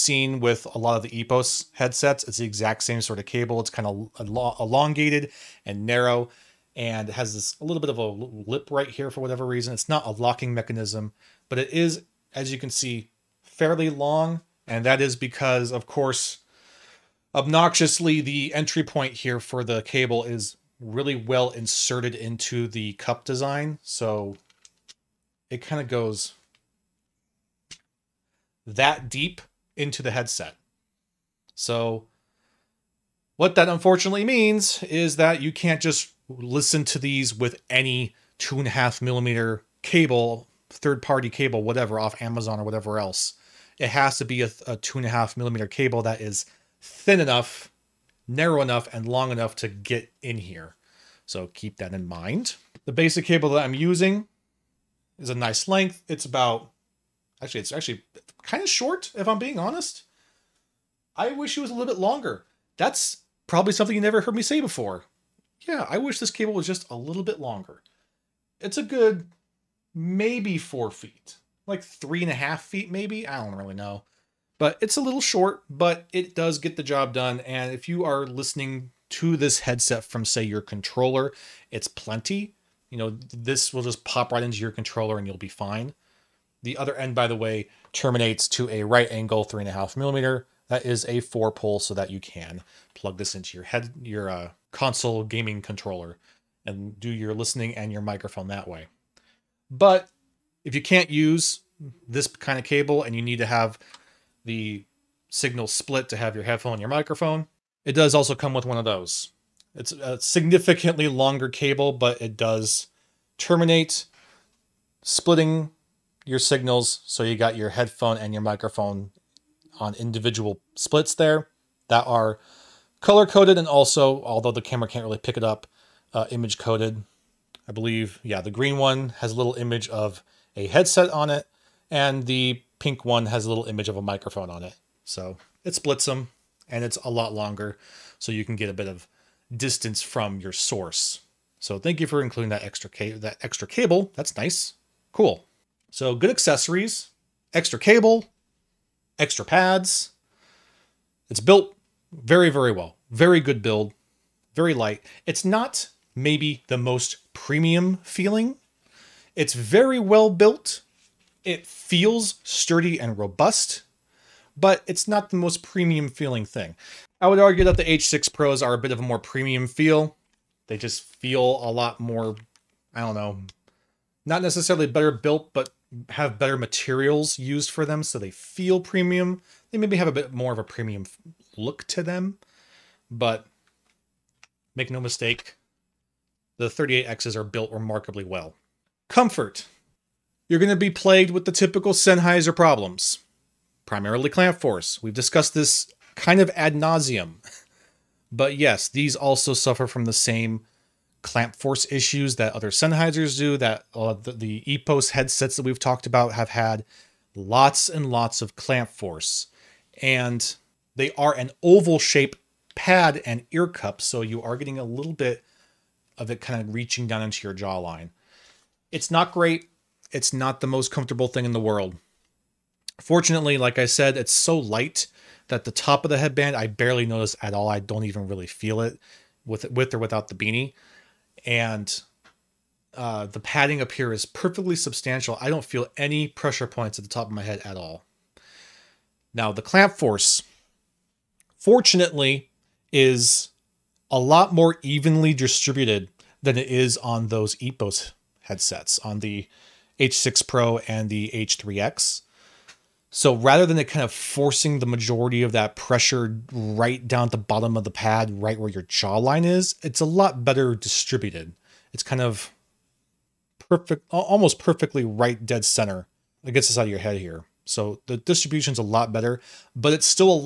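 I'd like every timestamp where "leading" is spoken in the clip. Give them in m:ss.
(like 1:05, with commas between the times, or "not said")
not said.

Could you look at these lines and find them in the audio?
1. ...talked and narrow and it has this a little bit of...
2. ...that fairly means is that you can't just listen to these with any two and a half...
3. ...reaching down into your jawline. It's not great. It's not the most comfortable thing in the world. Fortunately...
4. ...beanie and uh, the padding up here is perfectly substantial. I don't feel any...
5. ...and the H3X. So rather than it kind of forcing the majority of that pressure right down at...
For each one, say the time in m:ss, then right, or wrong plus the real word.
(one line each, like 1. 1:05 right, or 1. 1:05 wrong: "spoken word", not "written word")
1. 0:04 wrong: "elongated", not "talked"
2. 0:33 wrong: "unfortunately", not "fairly"
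3. 3:36 right
4. 3:50 right
5. 4:10 right.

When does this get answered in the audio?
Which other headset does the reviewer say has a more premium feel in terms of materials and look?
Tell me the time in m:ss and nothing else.
2:47.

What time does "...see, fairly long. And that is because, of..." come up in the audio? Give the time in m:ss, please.
0:12.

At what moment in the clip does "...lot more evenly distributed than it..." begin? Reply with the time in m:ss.
4:04.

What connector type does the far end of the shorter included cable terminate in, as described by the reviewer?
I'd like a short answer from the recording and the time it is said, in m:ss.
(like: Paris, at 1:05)
right angle 3.5mm, at 1:28.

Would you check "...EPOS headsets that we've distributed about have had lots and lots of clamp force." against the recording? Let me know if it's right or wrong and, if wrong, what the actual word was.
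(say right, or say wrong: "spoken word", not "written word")
wrong: "talked", not "distributed".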